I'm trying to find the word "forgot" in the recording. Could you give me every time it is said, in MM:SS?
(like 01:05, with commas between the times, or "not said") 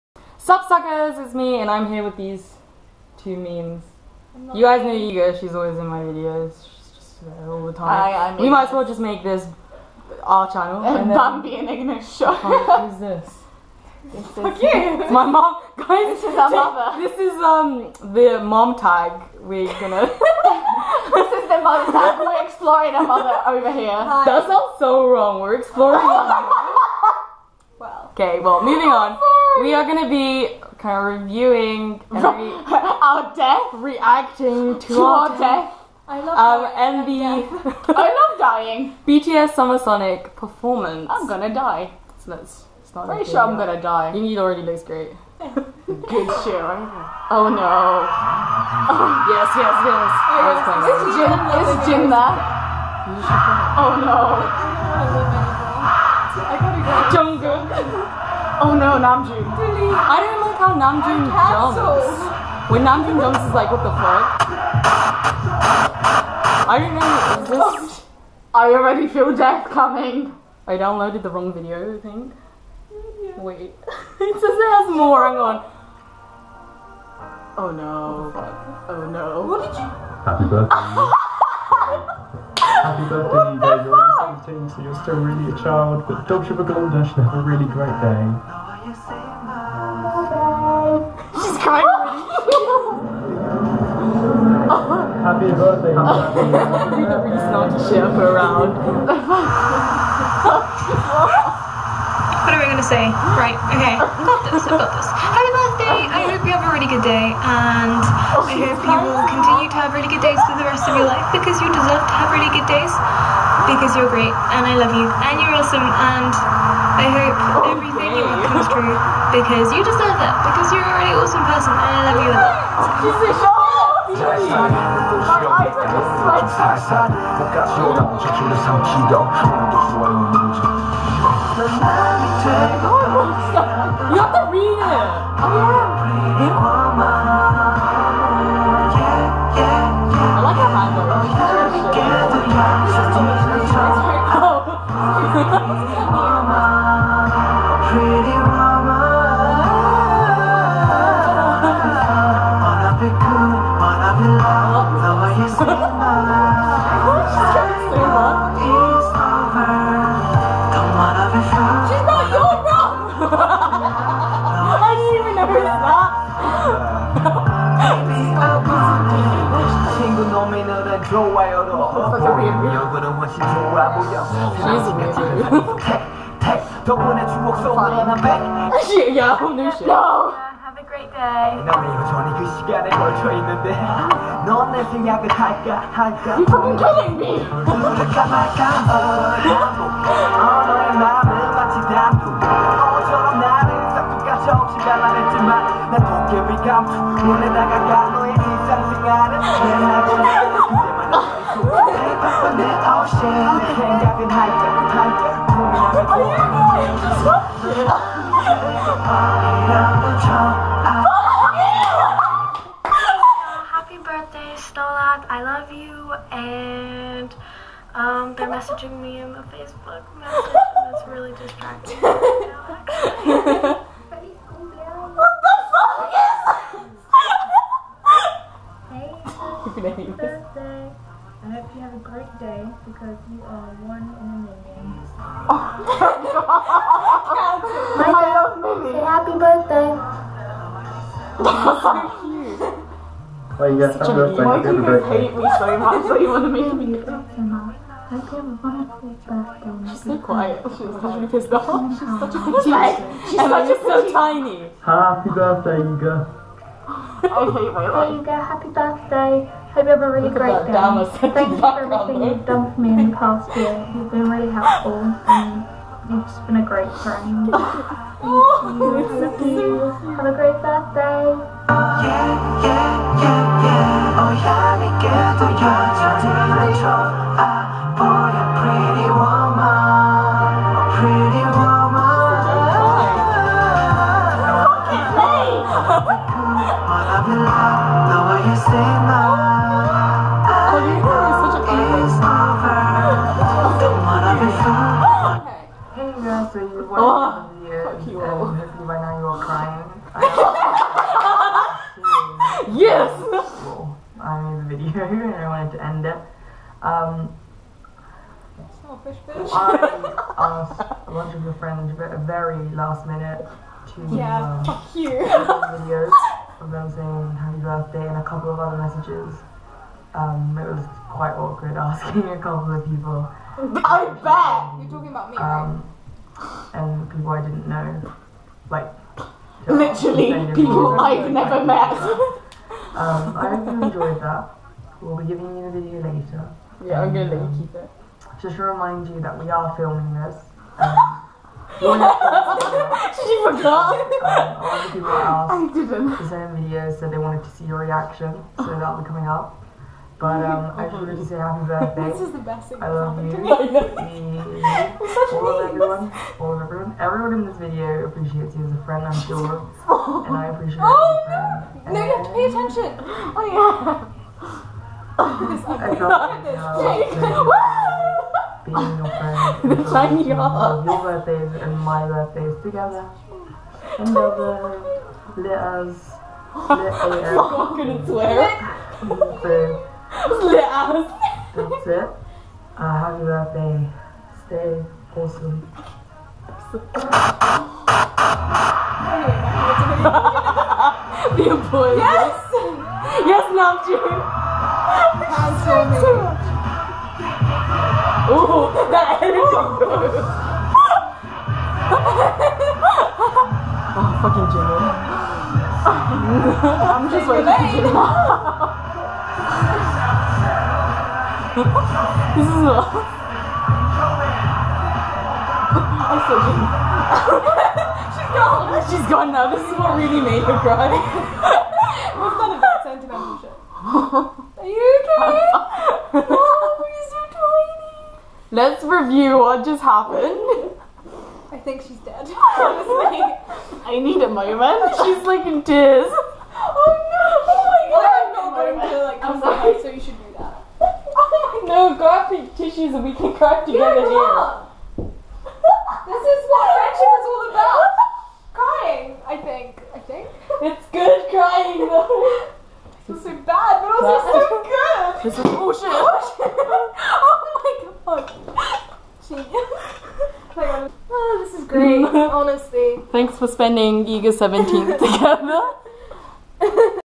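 05:43.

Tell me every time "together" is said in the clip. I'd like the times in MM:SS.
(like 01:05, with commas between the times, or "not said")
06:12, 07:23, 07:45.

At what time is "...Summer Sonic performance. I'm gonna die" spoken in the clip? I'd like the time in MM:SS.
00:39.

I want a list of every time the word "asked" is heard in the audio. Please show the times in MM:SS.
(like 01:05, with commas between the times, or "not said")
05:10, 05:45.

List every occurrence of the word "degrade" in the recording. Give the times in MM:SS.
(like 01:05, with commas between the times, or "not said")
not said.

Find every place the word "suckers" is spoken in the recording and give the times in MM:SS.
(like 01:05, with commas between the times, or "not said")
00:00.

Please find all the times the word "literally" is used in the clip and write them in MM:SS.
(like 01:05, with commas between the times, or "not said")
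04:10, 05:29.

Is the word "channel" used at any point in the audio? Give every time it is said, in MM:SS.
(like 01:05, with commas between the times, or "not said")
00:10.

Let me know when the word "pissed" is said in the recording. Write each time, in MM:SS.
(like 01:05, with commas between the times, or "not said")
04:11.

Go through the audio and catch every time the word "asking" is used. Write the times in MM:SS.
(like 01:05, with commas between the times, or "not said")
05:21.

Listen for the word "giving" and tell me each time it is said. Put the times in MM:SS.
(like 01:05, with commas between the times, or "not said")
05:35.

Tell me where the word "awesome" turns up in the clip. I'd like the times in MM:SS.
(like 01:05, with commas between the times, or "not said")
01:55, 02:01, 06:25.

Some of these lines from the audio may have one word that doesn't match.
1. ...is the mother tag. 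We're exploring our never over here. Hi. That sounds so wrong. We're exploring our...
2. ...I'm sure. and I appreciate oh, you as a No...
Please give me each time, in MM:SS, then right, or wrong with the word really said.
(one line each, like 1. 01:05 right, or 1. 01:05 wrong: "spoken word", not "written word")
1. 00:21 wrong: "mother", not "never"
2. 05:59 right.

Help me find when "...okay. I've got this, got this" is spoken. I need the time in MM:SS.
01:43.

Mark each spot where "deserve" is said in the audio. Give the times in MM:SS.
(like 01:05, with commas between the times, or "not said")
01:51, 01:59.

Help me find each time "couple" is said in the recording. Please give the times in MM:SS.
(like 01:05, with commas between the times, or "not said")
05:18, 05:22.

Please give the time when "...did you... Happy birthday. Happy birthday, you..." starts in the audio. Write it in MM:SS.
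01:19.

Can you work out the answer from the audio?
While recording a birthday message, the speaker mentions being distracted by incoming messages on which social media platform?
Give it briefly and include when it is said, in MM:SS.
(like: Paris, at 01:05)
Facebook, at 03:39.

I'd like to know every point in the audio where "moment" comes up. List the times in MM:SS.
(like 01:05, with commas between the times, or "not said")
07:14, 07:18.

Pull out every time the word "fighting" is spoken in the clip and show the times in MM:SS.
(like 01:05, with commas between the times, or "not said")
not said.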